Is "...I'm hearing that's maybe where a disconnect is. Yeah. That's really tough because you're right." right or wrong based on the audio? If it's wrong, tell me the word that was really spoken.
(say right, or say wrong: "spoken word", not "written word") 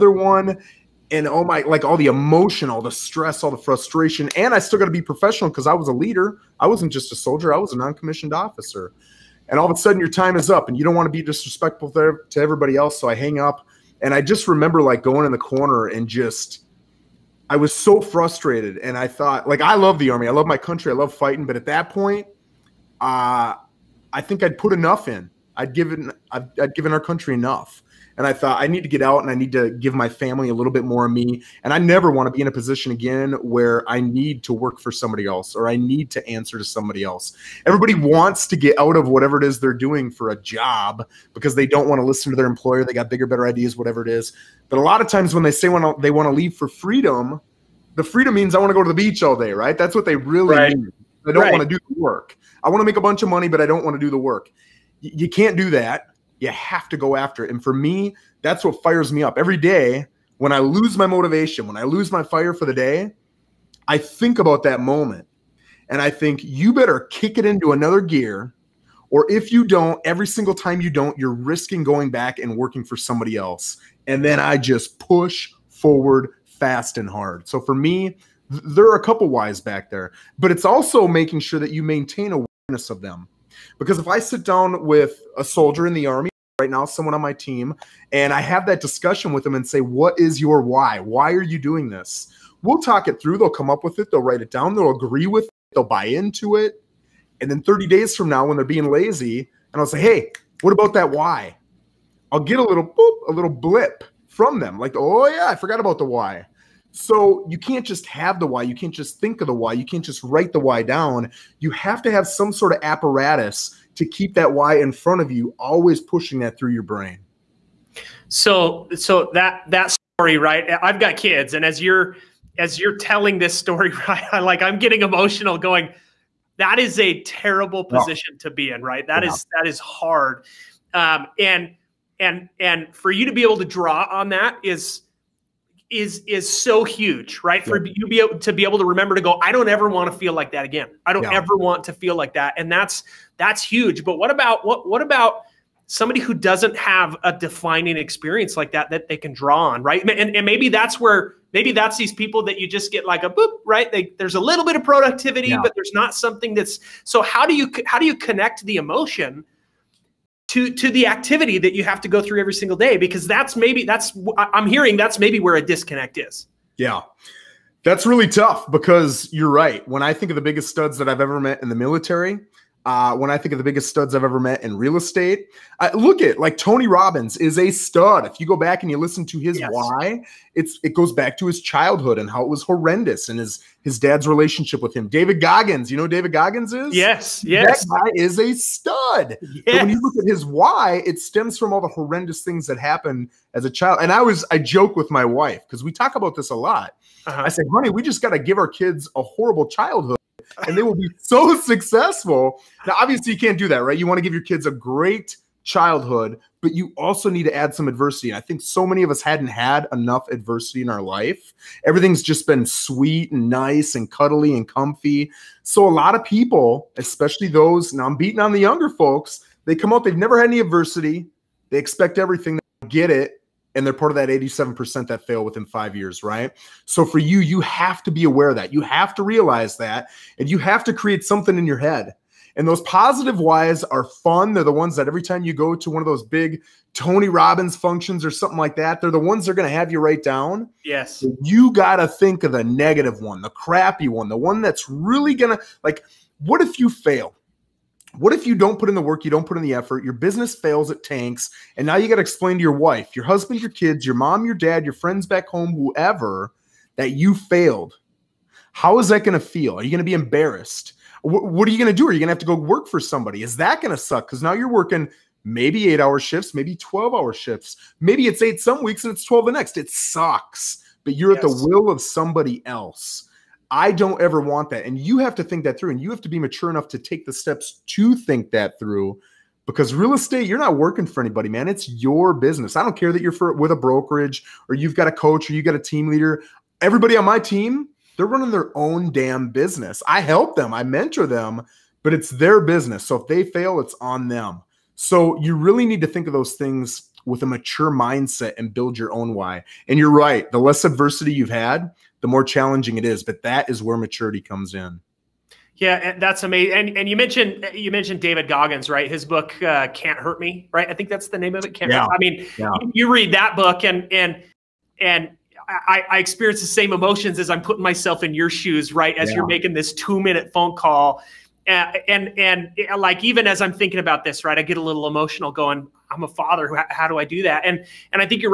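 right.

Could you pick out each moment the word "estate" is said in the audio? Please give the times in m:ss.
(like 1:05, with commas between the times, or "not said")
2:54, 4:40.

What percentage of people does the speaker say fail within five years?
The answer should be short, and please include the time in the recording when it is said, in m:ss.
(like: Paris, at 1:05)
87%, at 3:44.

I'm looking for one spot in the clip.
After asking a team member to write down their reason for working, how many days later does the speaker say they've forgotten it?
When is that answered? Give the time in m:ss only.
1:37.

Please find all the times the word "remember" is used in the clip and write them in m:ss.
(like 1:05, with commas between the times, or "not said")
0:14, 2:18.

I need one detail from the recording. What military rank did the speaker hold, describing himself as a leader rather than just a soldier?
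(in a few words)
Non-commissioned officer.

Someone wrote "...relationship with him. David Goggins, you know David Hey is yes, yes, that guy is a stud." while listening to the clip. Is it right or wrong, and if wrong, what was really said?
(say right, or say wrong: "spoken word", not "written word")
wrong: "Goggins", not "Hey".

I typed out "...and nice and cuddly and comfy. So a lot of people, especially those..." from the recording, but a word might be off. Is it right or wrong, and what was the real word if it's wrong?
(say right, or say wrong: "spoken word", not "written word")
right.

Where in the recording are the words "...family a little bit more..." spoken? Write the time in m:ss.
0:30.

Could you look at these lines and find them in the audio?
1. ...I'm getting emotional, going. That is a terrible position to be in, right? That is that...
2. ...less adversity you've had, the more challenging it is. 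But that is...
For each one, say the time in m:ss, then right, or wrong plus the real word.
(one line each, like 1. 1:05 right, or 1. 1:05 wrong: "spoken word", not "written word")
1. 2:04 right
2. 5:00 right.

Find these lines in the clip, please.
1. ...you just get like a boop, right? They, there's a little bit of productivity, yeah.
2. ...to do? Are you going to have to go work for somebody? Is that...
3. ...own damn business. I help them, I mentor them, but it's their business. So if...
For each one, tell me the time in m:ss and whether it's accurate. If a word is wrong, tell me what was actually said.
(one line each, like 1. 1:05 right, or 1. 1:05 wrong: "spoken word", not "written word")
1. 2:32 right
2. 4:21 right
3. 4:48 right.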